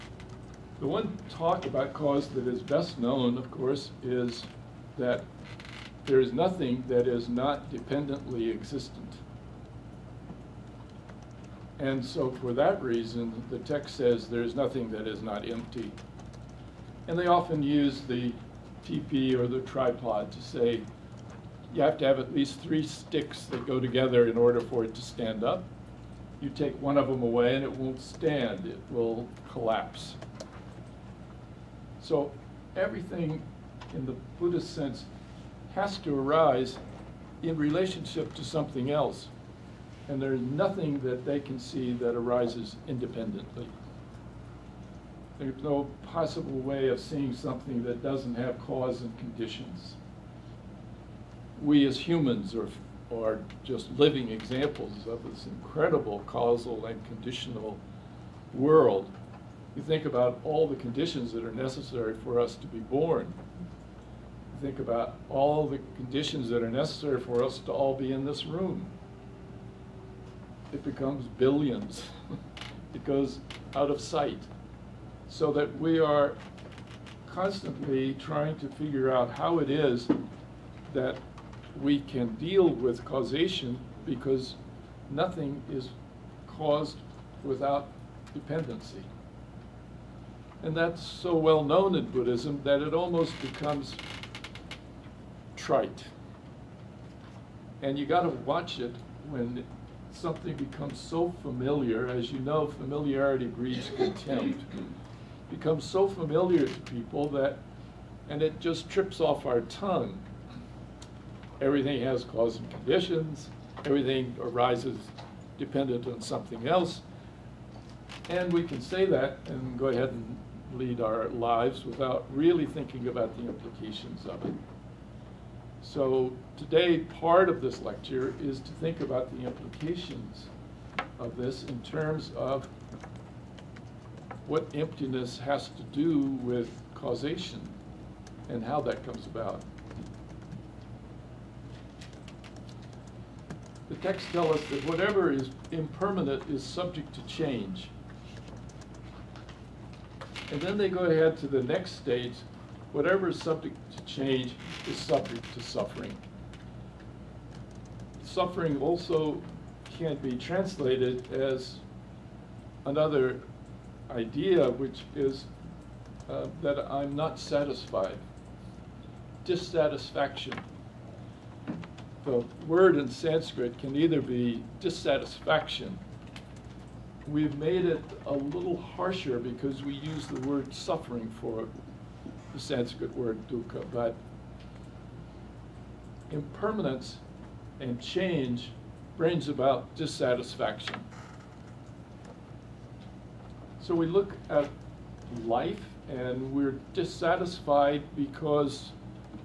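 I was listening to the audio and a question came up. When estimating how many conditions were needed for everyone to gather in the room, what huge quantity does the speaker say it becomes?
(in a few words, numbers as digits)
Billions.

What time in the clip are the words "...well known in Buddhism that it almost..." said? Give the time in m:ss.
1:31.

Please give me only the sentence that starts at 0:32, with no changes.
So everything in the Buddhist sense has to arise in relationship to something else.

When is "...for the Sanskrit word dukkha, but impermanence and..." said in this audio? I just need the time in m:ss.
3:01.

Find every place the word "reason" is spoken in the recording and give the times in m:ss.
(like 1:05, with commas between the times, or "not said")
0:12.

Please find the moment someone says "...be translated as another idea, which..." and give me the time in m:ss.
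2:40.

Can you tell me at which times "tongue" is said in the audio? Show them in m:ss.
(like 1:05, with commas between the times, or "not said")
1:49.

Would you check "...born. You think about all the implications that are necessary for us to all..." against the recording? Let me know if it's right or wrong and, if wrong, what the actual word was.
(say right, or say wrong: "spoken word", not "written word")
wrong: "conditions", not "implications".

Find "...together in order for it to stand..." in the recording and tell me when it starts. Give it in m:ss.
0:23.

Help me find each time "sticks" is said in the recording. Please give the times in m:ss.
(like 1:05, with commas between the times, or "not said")
0:22.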